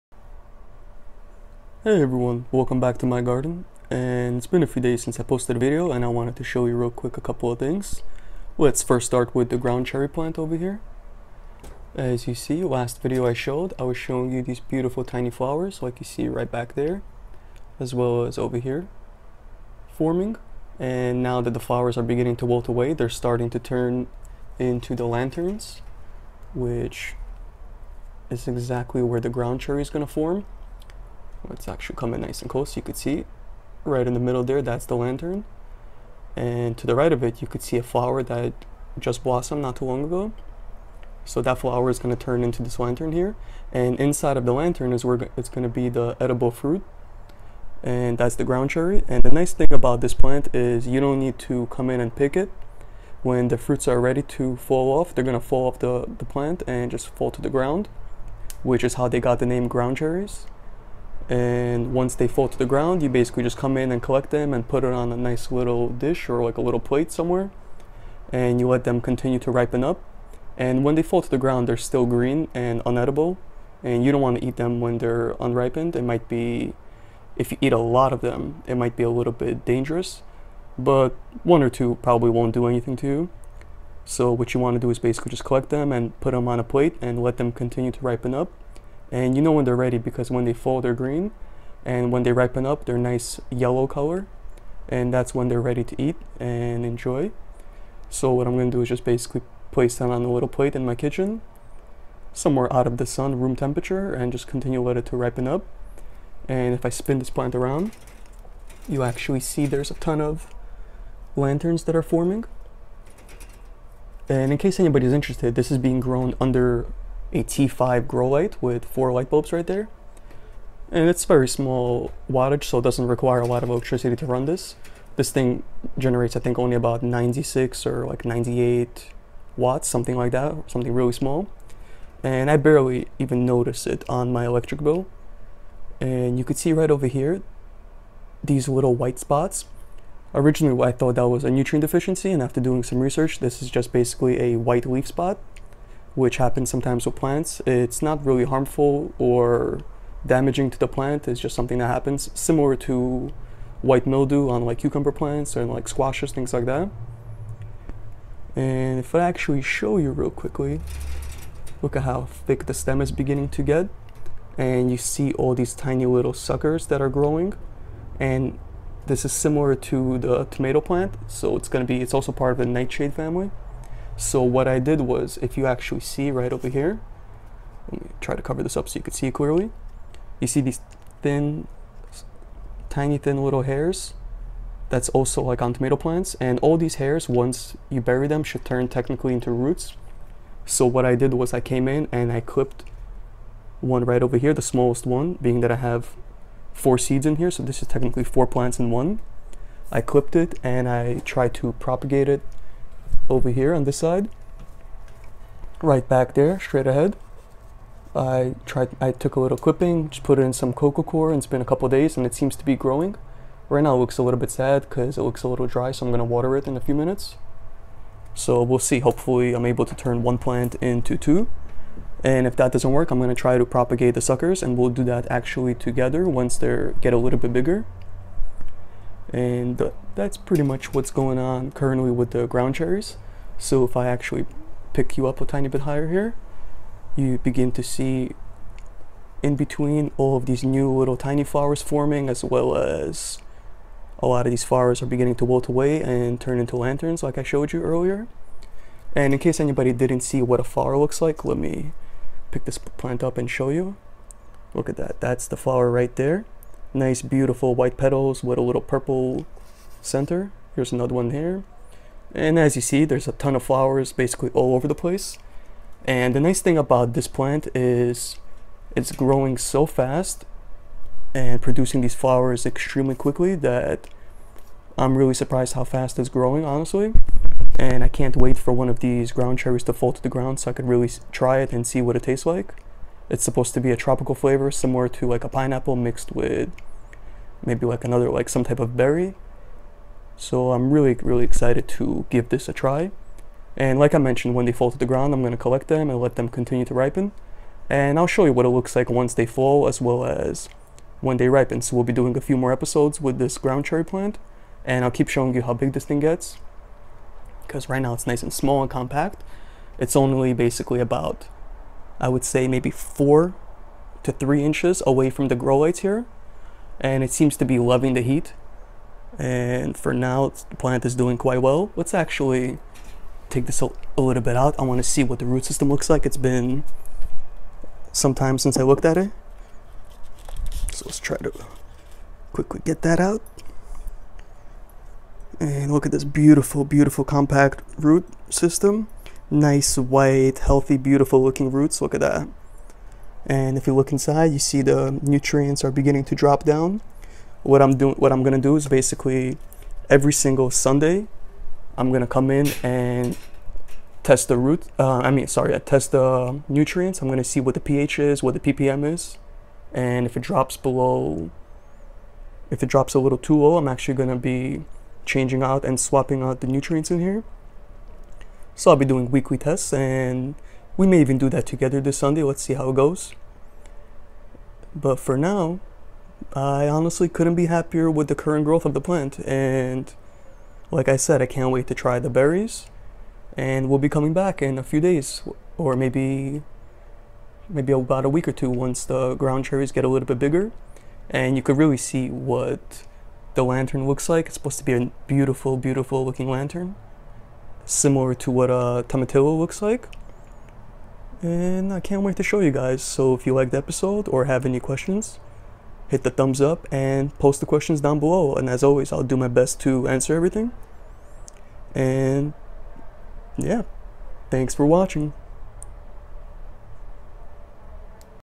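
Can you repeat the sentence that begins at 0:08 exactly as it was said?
Let's first start with the ground cherry plant over here.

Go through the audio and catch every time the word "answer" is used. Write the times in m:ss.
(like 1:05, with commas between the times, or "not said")
6:50.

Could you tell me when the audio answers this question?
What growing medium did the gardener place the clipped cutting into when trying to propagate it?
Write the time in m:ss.
3:30.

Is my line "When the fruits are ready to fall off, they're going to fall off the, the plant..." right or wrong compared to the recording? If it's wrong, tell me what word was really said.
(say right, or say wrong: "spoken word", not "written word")
right.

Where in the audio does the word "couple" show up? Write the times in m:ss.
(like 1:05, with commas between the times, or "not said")
0:07, 3:31.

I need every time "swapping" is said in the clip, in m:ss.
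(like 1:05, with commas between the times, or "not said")
6:05.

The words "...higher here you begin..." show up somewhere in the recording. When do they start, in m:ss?
3:55.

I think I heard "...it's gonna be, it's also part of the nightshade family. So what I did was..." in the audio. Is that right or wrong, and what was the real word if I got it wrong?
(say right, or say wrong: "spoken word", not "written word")
right.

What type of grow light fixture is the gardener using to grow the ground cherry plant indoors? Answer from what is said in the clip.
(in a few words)
T5 grow light.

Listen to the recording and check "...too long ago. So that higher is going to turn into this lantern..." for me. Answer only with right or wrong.
wrong.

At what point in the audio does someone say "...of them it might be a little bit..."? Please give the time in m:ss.
1:18.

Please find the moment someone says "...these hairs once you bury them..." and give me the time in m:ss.
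3:06.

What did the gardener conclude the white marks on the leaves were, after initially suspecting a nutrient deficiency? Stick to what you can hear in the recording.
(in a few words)
White leaf spot.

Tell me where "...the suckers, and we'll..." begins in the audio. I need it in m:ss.
3:44.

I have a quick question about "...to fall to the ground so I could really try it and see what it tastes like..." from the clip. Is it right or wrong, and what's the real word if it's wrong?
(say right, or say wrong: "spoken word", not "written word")
right.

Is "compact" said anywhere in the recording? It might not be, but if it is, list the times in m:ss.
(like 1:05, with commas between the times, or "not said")
5:08, 5:37.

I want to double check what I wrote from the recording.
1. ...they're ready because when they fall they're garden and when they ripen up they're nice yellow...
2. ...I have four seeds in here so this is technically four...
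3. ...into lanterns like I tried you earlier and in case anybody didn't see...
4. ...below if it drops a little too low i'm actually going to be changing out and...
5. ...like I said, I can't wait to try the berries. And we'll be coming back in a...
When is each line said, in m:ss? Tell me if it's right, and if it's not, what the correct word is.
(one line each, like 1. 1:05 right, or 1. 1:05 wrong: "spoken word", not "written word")
1. 1:29 wrong: "green", not "garden"
2. 3:15 right
3. 4:06 wrong: "showed", not "tried"
4. 6:00 right
5. 6:20 right.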